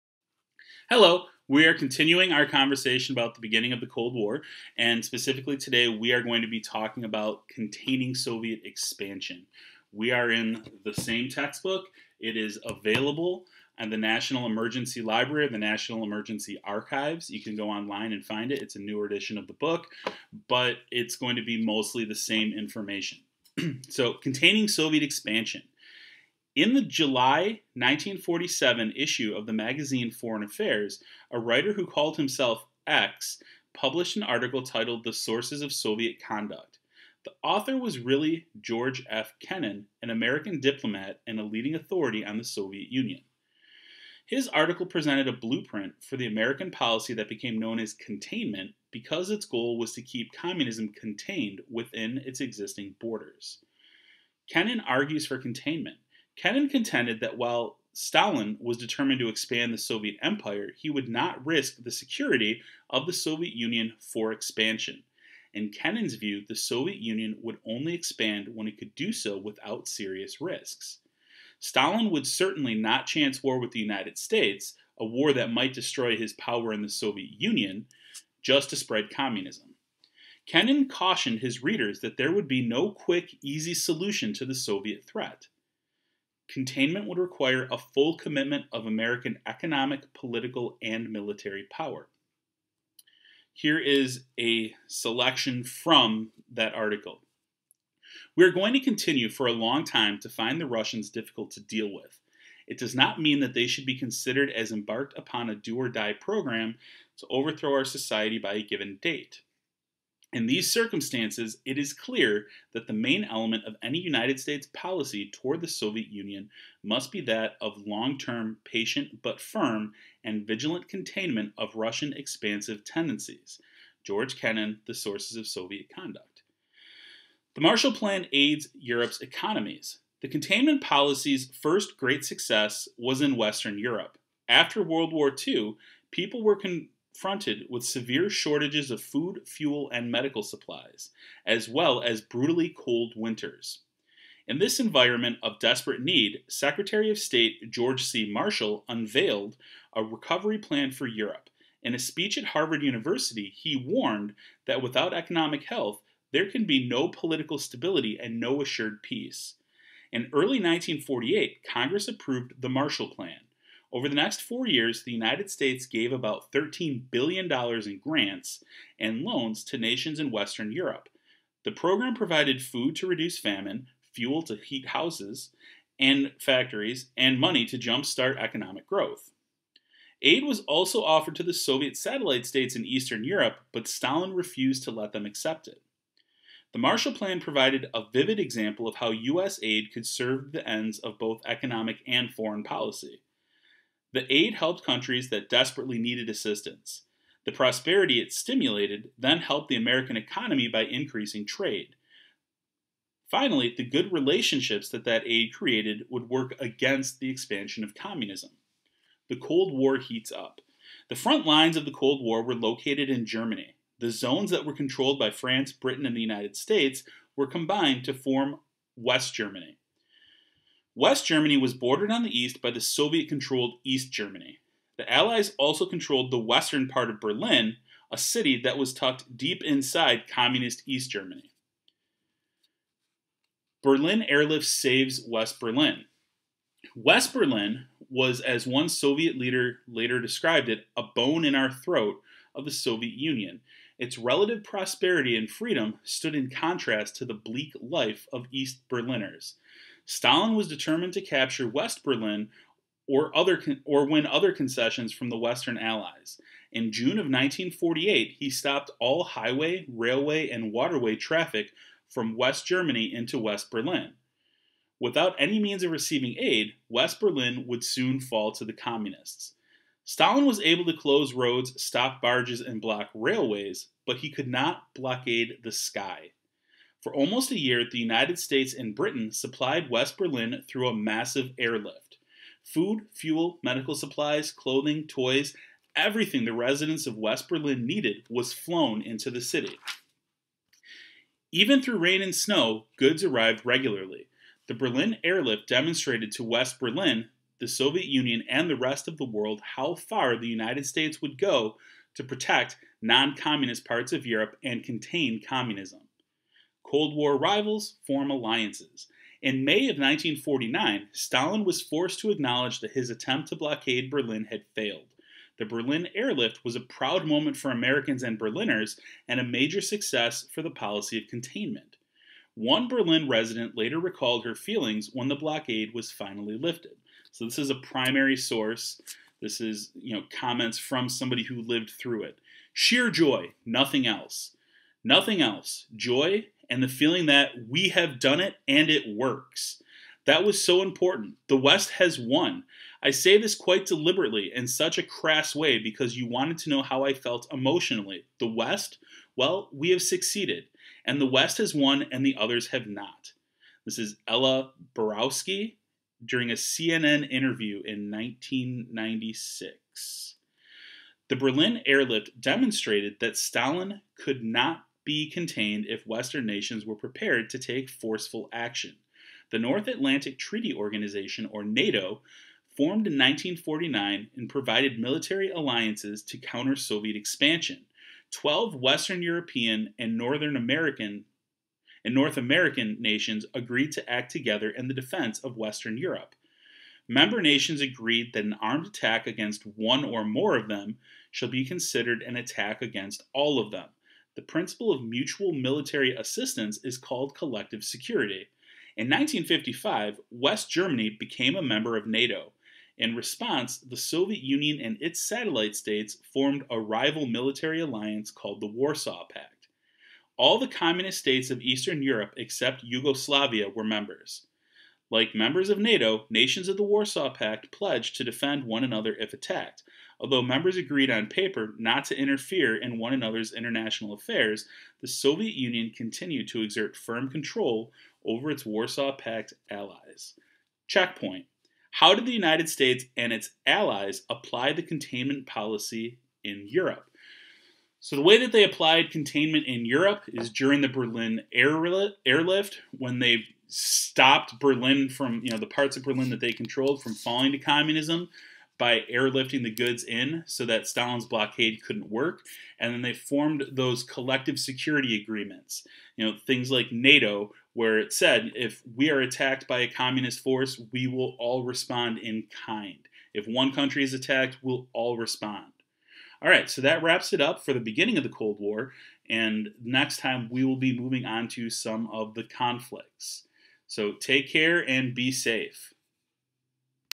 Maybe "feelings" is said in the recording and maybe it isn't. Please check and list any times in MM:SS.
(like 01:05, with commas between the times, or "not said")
05:24, 05:36.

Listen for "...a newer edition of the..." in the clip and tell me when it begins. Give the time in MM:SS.
00:18.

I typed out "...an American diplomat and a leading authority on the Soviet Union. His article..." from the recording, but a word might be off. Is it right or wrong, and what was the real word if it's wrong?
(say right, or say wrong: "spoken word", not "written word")
right.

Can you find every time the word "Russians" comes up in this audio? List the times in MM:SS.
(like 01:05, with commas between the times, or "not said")
01:40, 02:01.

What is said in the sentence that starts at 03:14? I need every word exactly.
The aid helped countries that desperately needed assistance.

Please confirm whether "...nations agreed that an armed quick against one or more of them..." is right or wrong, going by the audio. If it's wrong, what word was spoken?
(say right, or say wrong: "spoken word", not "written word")
wrong: "attack", not "quick".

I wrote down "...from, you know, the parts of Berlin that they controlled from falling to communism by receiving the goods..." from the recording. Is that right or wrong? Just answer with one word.
wrong.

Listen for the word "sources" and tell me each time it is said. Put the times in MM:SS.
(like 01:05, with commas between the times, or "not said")
00:35, 02:04, 05:28.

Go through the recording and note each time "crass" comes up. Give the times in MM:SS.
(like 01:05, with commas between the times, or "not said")
05:45.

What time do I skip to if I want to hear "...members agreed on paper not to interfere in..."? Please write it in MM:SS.
07:00.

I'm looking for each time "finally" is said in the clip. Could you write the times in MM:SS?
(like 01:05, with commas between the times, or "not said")
03:23, 05:26.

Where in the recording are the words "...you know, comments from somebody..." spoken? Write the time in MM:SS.
05:29.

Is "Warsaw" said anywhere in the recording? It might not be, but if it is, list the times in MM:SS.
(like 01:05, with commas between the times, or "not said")
06:48, 06:56, 07:08.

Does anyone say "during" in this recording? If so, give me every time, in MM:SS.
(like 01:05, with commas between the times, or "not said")
05:56, 07:20.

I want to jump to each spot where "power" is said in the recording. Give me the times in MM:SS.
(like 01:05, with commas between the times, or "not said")
01:16, 01:31.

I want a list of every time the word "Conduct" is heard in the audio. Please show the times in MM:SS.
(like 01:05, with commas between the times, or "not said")
00:36, 02:05.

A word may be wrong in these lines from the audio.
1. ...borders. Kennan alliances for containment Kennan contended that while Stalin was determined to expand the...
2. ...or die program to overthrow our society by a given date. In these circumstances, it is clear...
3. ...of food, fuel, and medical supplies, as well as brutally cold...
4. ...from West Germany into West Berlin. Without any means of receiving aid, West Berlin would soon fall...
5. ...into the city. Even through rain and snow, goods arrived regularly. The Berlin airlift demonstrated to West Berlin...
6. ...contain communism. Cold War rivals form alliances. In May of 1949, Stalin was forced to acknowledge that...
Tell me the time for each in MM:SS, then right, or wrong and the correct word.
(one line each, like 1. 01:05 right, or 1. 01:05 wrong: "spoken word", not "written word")
1. 00:52 wrong: "argues", not "alliances"
2. 01:45 right
3. 02:18 right
4. 04:22 right
5. 04:49 right
6. 05:04 right.